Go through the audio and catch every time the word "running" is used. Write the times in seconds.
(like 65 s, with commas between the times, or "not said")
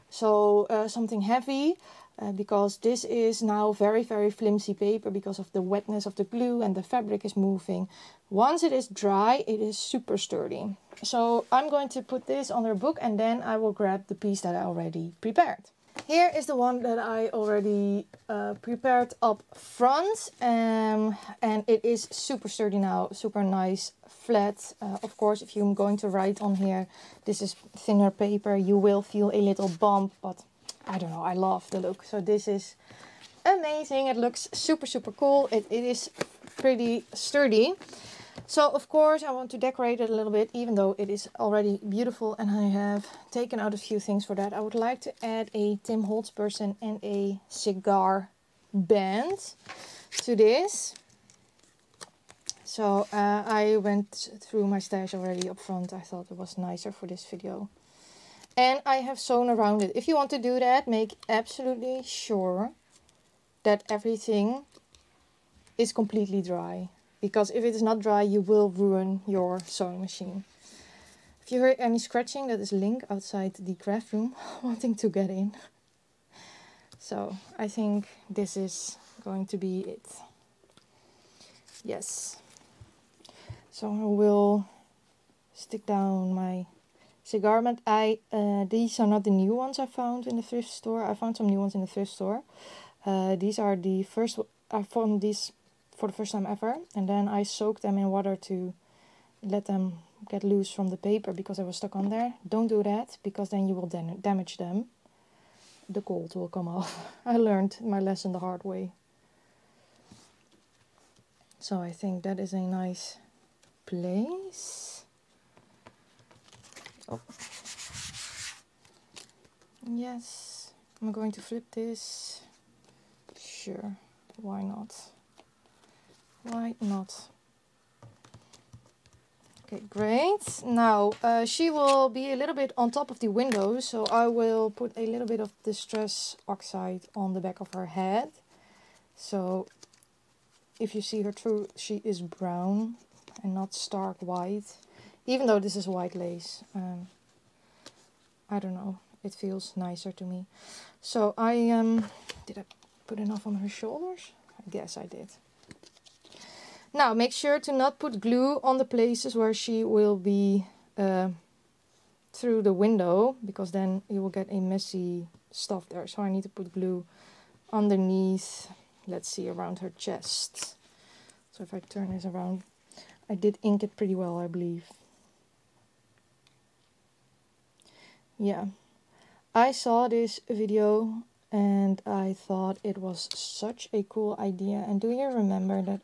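not said.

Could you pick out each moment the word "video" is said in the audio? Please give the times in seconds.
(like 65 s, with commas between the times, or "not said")
57 s, 180 s.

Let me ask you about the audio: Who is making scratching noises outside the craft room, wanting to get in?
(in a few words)
Link.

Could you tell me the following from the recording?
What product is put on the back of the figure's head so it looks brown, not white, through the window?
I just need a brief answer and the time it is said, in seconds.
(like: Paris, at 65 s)
Distress Oxide, at 135 s.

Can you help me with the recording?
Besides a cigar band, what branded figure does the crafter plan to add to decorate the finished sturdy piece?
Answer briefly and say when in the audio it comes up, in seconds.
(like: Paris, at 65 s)
Tim Holtz person, at 45 s.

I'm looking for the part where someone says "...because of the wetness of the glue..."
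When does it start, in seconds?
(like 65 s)
5 s.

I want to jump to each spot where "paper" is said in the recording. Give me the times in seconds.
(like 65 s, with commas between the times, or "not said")
4 s, 28 s, 100 s.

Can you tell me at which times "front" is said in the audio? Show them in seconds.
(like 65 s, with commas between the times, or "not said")
19 s, 55 s.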